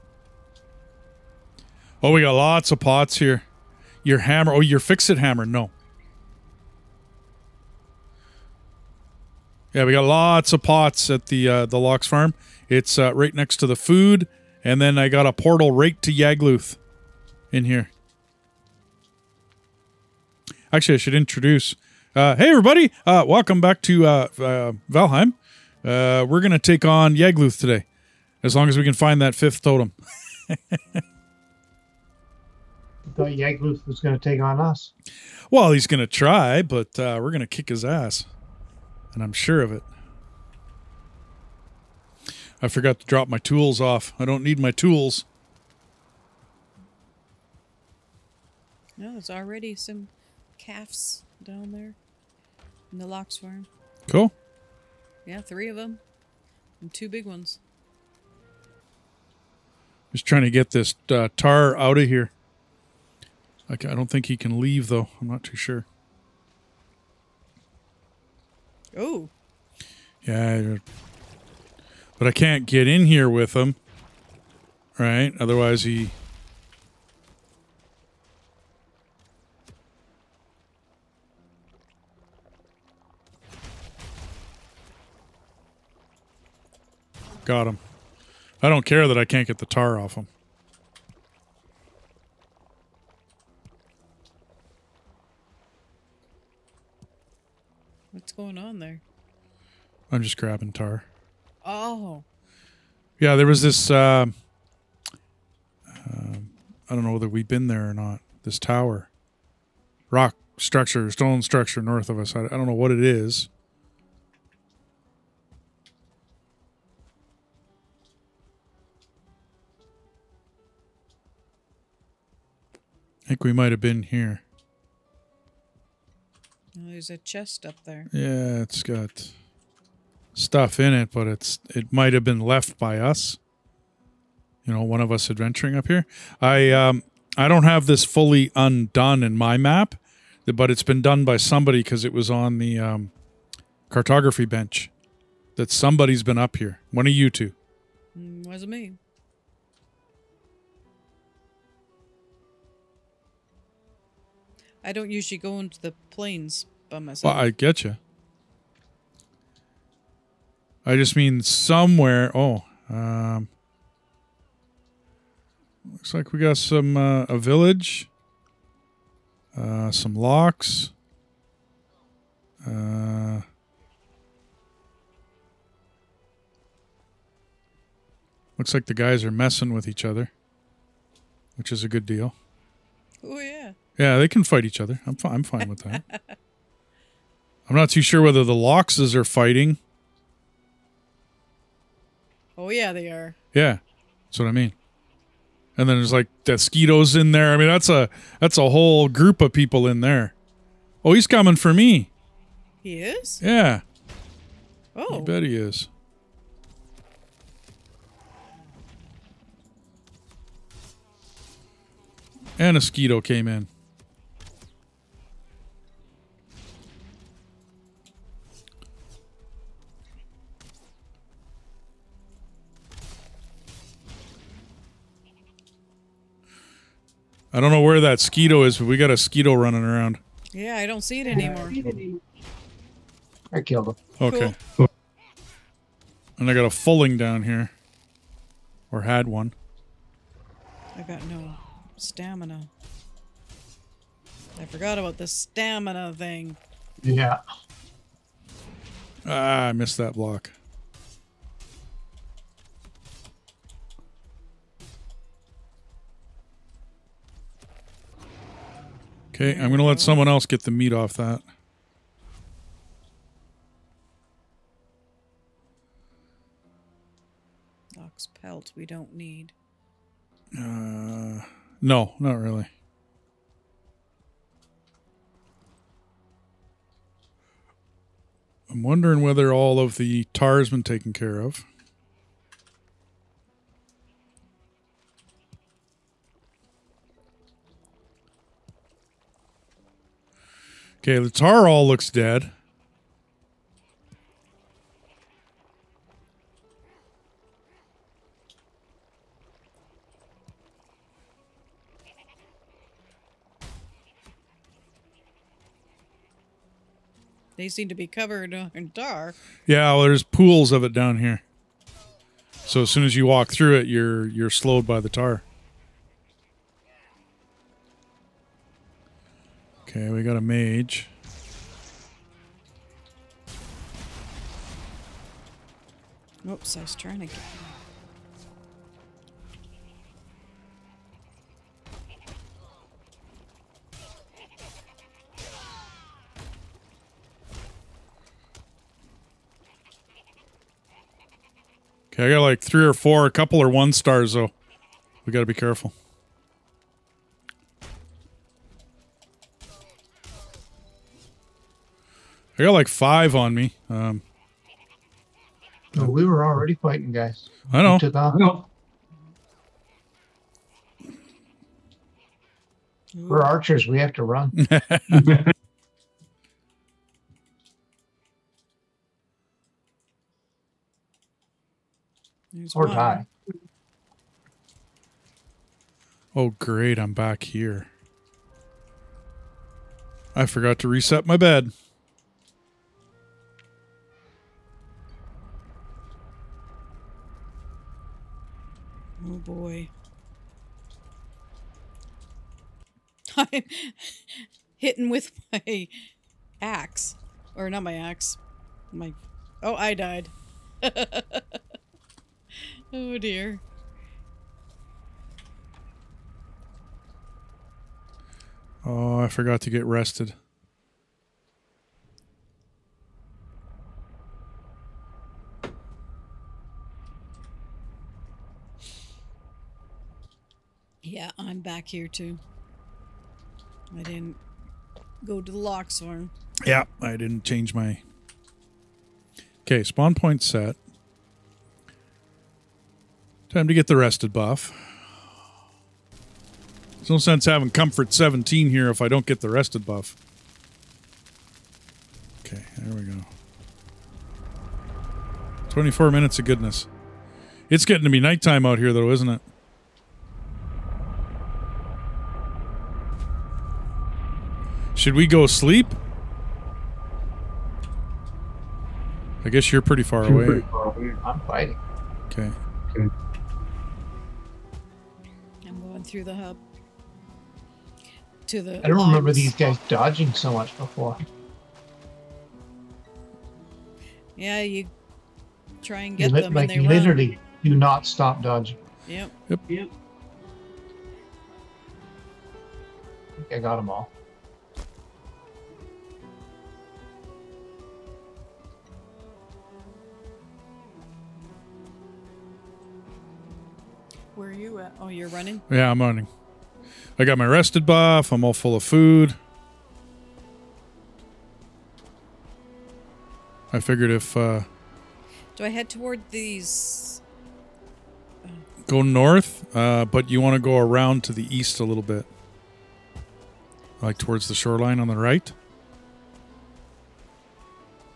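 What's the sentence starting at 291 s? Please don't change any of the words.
Okay, the tar all looks dead.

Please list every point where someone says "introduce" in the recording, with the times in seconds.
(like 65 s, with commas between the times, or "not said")
21 s.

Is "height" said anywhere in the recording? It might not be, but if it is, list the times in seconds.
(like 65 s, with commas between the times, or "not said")
not said.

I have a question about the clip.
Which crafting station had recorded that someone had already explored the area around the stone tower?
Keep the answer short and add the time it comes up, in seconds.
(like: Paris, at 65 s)
cartography bench, at 143 s.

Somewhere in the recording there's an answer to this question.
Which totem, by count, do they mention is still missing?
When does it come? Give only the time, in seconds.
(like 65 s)
29 s.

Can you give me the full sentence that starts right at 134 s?
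You know, one of us adventuring up here.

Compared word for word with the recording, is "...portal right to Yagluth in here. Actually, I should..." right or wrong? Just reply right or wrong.
right.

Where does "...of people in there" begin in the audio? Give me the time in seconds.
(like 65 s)
199 s.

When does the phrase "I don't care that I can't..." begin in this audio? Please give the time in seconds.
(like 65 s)
88 s.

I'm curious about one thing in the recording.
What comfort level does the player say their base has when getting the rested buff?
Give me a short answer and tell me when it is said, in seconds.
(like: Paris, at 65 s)
17, at 437 s.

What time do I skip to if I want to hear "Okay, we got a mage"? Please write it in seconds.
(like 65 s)
319 s.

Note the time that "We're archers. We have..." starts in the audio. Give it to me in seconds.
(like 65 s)
363 s.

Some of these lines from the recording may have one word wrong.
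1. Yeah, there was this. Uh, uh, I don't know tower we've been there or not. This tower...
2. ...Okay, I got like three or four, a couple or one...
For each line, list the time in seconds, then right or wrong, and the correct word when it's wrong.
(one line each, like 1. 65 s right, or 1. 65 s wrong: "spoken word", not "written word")
1. 103 s wrong: "whether", not "tower"
2. 342 s right.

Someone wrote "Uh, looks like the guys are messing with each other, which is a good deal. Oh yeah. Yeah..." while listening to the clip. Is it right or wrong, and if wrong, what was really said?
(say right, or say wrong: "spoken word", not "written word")
right.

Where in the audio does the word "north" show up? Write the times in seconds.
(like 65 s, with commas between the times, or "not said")
111 s, 509 s.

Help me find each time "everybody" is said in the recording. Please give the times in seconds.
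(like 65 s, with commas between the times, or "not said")
22 s.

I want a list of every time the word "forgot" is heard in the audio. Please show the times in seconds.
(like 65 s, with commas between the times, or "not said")
42 s, 244 s, 380 s, 409 s.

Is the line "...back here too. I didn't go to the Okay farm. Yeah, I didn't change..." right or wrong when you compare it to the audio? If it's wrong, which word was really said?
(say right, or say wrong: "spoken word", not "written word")
wrong: "Lox", not "Okay".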